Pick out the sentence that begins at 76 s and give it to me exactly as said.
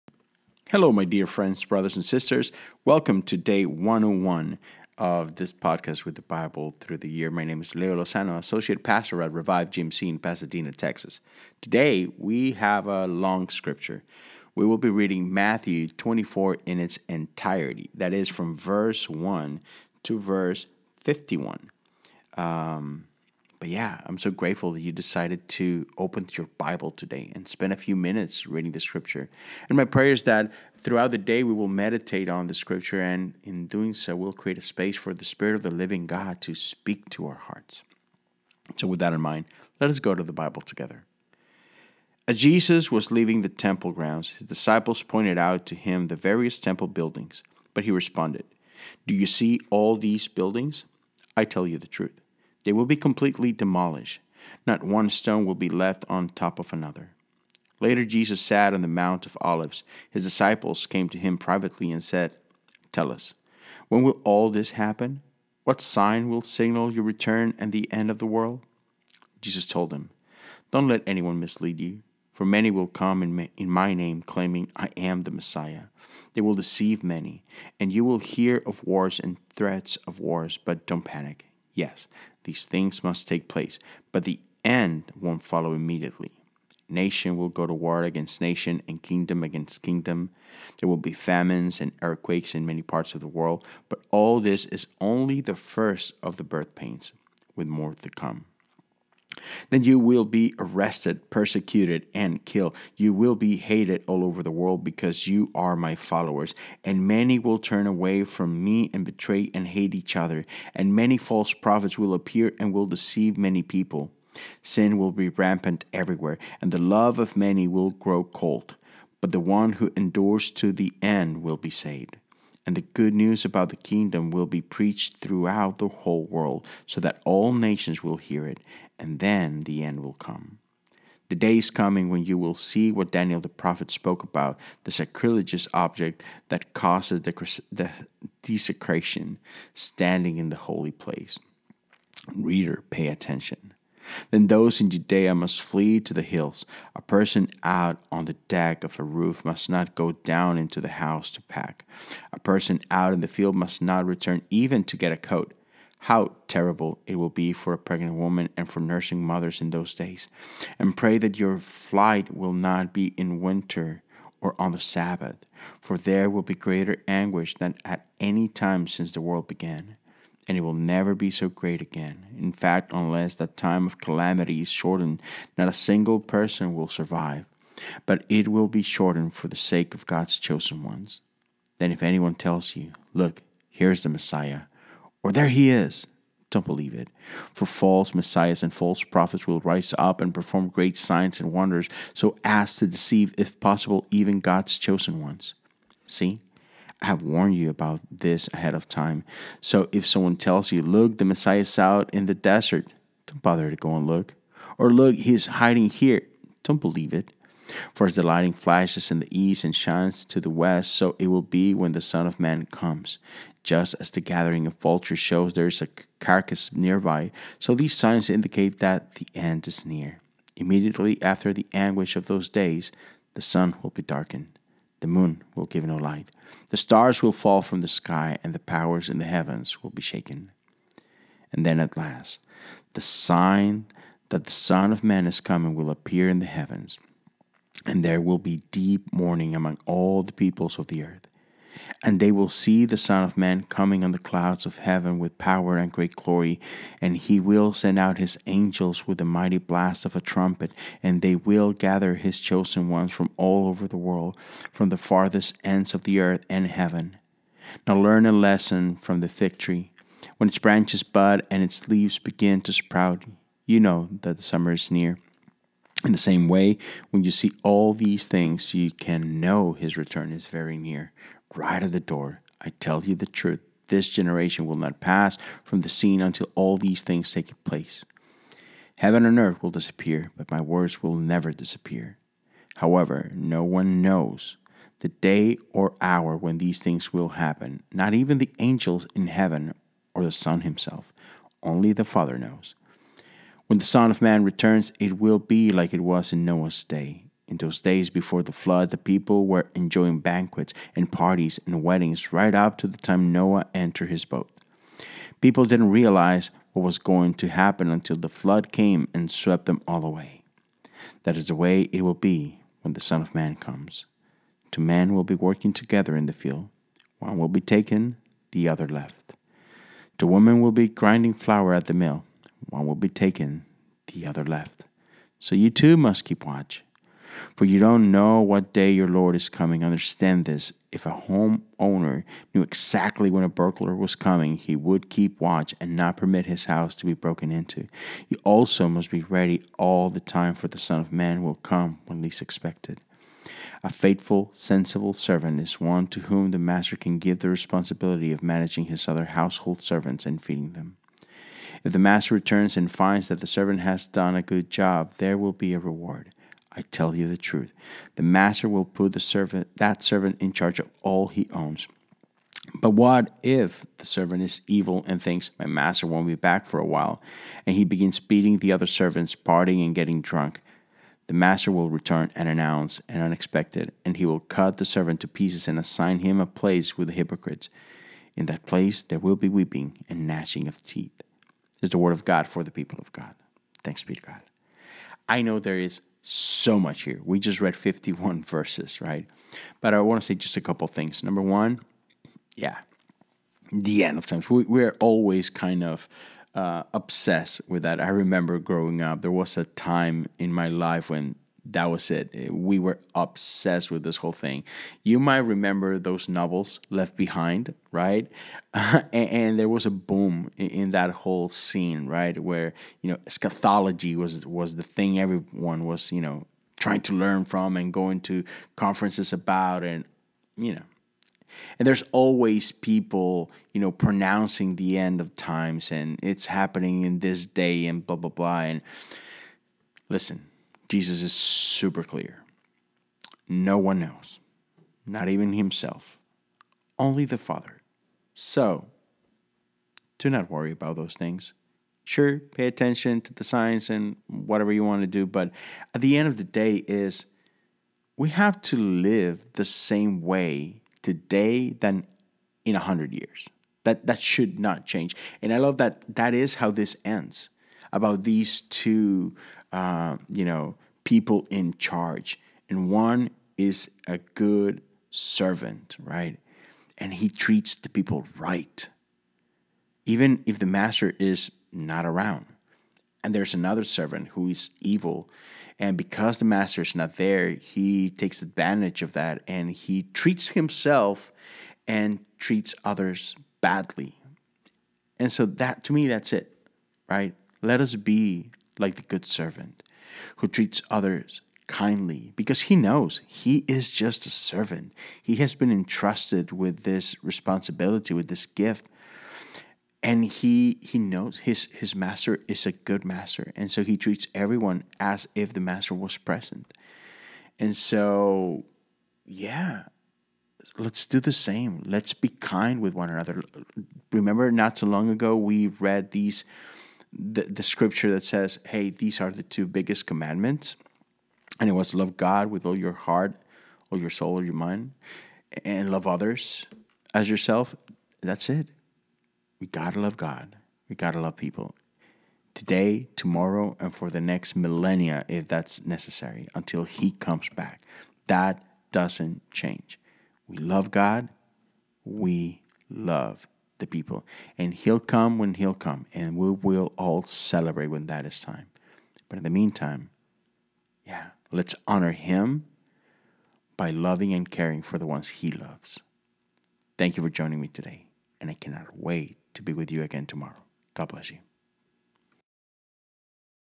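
They will deceive many, and you will hear of wars and threats of wars, but don't panic.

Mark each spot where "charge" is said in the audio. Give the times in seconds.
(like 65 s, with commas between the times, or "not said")
360 s, 461 s.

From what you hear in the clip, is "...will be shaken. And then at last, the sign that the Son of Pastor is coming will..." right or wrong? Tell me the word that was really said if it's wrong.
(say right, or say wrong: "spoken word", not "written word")
wrong: "Man", not "Pastor".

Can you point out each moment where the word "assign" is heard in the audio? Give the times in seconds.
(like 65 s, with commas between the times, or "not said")
375 s.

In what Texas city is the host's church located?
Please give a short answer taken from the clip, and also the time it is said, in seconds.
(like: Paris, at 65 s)
Pasadena, at 10 s.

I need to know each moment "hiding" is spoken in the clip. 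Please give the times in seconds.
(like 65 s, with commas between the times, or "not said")
205 s.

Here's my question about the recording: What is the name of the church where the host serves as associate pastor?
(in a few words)
Revive GMC.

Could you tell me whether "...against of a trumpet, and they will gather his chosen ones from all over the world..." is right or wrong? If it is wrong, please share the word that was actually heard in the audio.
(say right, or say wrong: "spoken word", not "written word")
wrong: "blast", not "against".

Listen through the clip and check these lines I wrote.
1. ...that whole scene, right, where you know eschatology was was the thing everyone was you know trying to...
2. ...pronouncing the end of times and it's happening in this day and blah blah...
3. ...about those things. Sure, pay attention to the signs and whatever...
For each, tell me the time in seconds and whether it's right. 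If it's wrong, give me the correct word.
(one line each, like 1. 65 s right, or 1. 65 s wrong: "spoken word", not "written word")
1. 410 s right
2. 423 s right
3. 440 s right.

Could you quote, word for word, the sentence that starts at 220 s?
Immediately after the anguish of those days, the sun will be darkened the moon will give no light.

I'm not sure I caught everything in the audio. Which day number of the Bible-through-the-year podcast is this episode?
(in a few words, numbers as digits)
101.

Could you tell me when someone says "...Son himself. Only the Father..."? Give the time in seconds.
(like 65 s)
290 s.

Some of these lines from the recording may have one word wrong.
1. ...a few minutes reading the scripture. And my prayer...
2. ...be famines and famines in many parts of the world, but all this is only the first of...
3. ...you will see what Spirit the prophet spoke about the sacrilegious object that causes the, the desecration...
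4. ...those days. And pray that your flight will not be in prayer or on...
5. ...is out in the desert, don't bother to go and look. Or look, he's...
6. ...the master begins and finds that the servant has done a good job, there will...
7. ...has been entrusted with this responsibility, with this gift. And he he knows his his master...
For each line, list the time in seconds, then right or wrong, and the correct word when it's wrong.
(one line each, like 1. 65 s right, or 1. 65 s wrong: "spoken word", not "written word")
1. 27 s right
2. 90 s wrong: "earthquakes", not "famines"
3. 132 s wrong: "Daniel", not "Spirit"
4. 159 s wrong: "winter", not "prayer"
5. 201 s right
6. 351 s wrong: "returns", not "begins"
7. 495 s right.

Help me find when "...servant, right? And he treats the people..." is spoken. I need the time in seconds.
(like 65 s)
465 s.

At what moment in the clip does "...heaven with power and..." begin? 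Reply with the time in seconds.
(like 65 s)
244 s.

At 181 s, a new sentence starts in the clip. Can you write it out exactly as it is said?
Then, if anyone tells you, Look, here's the Messiah, or there he is, don't believe it.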